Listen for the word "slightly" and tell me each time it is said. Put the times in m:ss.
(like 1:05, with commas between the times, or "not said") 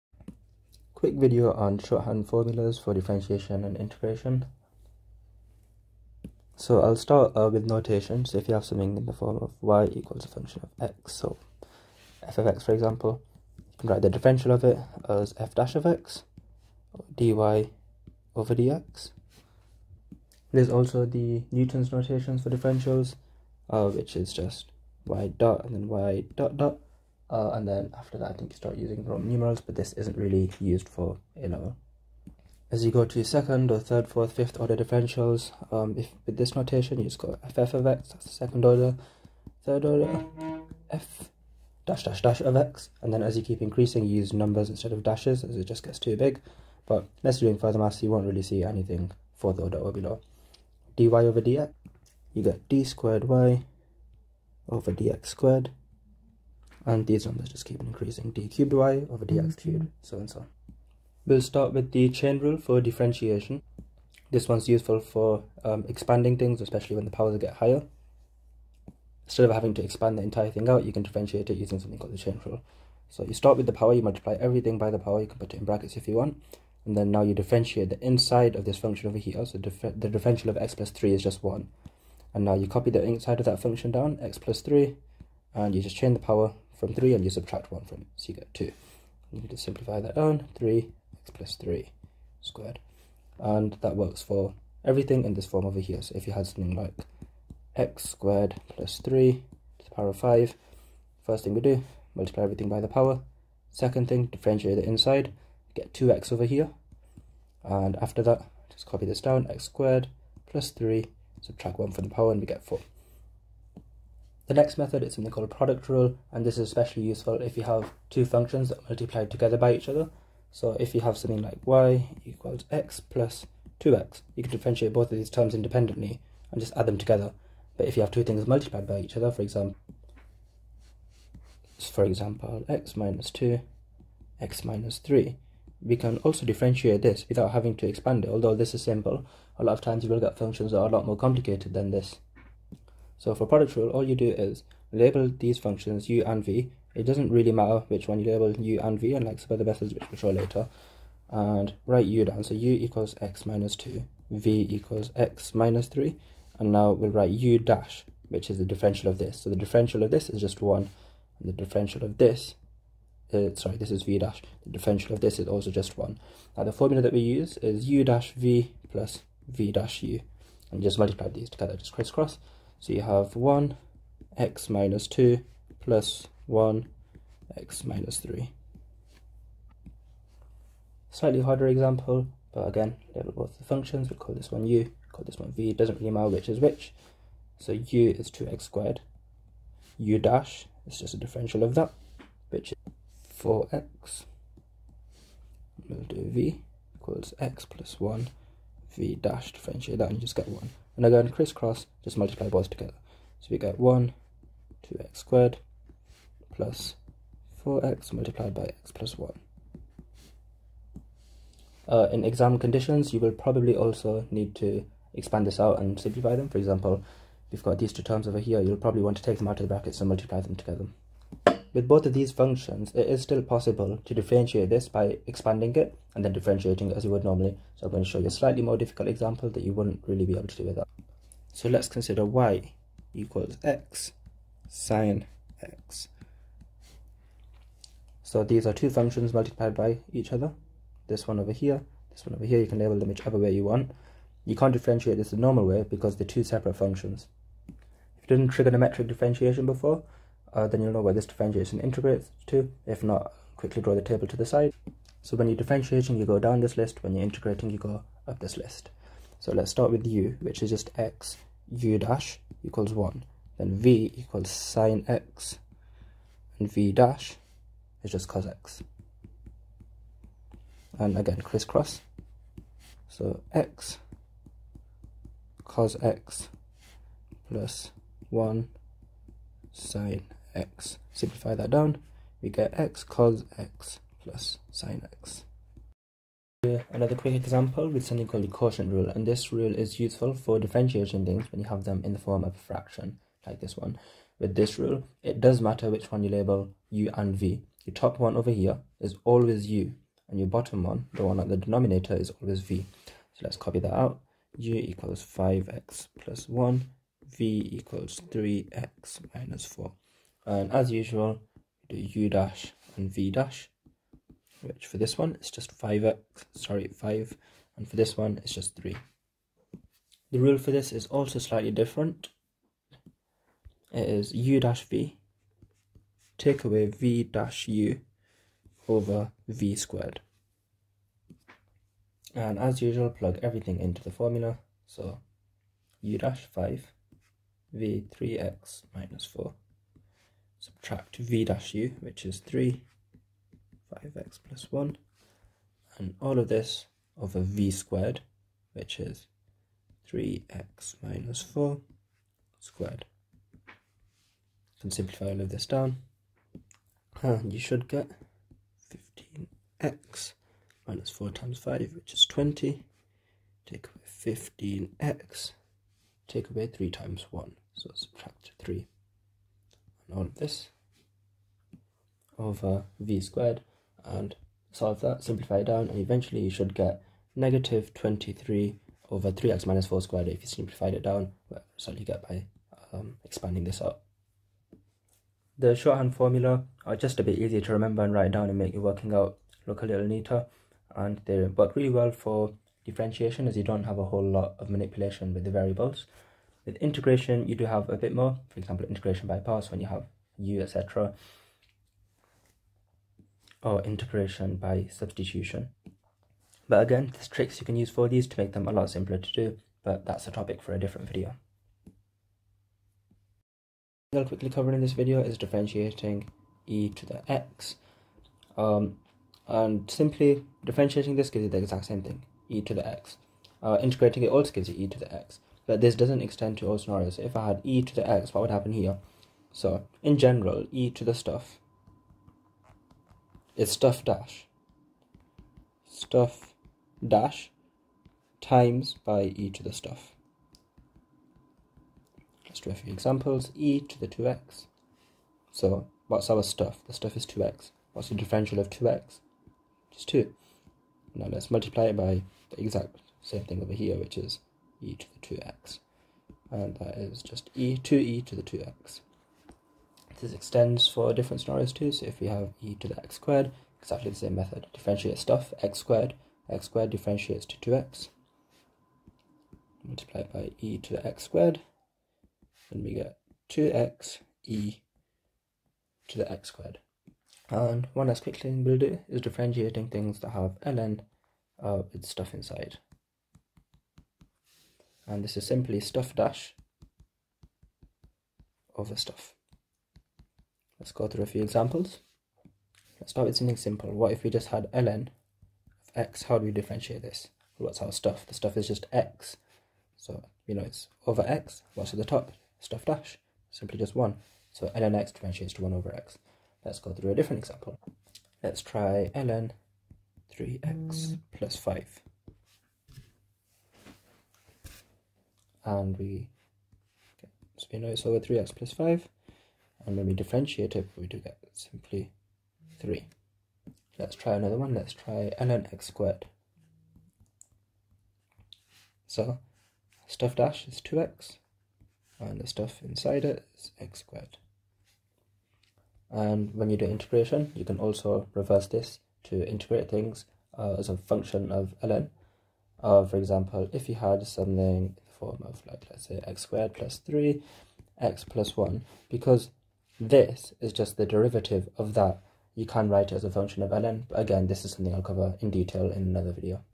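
3:01, 3:48, 5:21.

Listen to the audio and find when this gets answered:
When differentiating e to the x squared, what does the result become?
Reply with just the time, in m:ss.
7:53.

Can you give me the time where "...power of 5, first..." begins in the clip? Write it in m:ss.
1:39.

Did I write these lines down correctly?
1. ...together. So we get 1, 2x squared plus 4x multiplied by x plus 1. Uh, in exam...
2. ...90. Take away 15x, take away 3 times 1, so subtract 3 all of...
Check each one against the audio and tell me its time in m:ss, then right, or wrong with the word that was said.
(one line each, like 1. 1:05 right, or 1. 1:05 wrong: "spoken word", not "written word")
1. 3:22 right
2. 6:02 wrong: "20", not "90".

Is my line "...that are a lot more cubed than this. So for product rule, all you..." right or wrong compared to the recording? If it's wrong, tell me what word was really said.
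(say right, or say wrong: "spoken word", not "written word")
wrong: "complicated", not "cubed".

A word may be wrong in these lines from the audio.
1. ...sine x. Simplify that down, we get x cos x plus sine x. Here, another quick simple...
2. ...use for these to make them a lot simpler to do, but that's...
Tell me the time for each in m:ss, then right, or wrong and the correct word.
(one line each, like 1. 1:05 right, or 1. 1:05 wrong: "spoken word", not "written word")
1. 4:39 wrong: "example", not "simple"
2. 6:47 right.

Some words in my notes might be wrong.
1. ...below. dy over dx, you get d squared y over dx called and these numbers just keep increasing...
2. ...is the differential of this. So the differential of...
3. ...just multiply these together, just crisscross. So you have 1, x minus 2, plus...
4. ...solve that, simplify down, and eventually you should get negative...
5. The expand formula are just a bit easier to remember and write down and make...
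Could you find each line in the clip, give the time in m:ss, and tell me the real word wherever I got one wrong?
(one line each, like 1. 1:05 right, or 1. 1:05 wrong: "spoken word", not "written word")
1. 0:49 wrong: "squared", not "called"
2. 2:38 right
3. 2:50 right
4. 6:14 right
5. 6:25 wrong: "shorthand", not "expand".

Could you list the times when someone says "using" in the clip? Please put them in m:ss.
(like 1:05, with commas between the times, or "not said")
0:28, 1:11.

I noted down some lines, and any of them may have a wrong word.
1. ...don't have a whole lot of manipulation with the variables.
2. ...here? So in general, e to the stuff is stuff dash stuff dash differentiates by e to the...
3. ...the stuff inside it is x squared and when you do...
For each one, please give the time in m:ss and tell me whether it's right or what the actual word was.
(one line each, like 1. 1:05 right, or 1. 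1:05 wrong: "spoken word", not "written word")
1. 6:33 right
2. 7:08 wrong: "times", not "differentiates"
3. 8:52 right.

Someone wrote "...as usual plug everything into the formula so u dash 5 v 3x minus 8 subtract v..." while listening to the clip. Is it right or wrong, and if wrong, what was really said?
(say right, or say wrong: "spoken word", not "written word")
wrong: "4", not "8".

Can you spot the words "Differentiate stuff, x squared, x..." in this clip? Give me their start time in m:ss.
7:44.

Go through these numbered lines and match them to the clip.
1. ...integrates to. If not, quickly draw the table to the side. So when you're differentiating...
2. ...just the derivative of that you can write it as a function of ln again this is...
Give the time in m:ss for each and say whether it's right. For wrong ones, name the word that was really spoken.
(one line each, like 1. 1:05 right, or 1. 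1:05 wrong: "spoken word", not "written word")
1. 4:11 right
2. 9:10 right.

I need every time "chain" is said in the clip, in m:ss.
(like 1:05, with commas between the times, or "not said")
1:02, 1:12, 1:25.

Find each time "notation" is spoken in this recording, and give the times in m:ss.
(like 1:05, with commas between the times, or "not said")
0:07, 0:21, 0:36.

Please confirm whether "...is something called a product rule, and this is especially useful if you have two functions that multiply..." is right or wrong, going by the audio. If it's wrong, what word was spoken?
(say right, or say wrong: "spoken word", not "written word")
right.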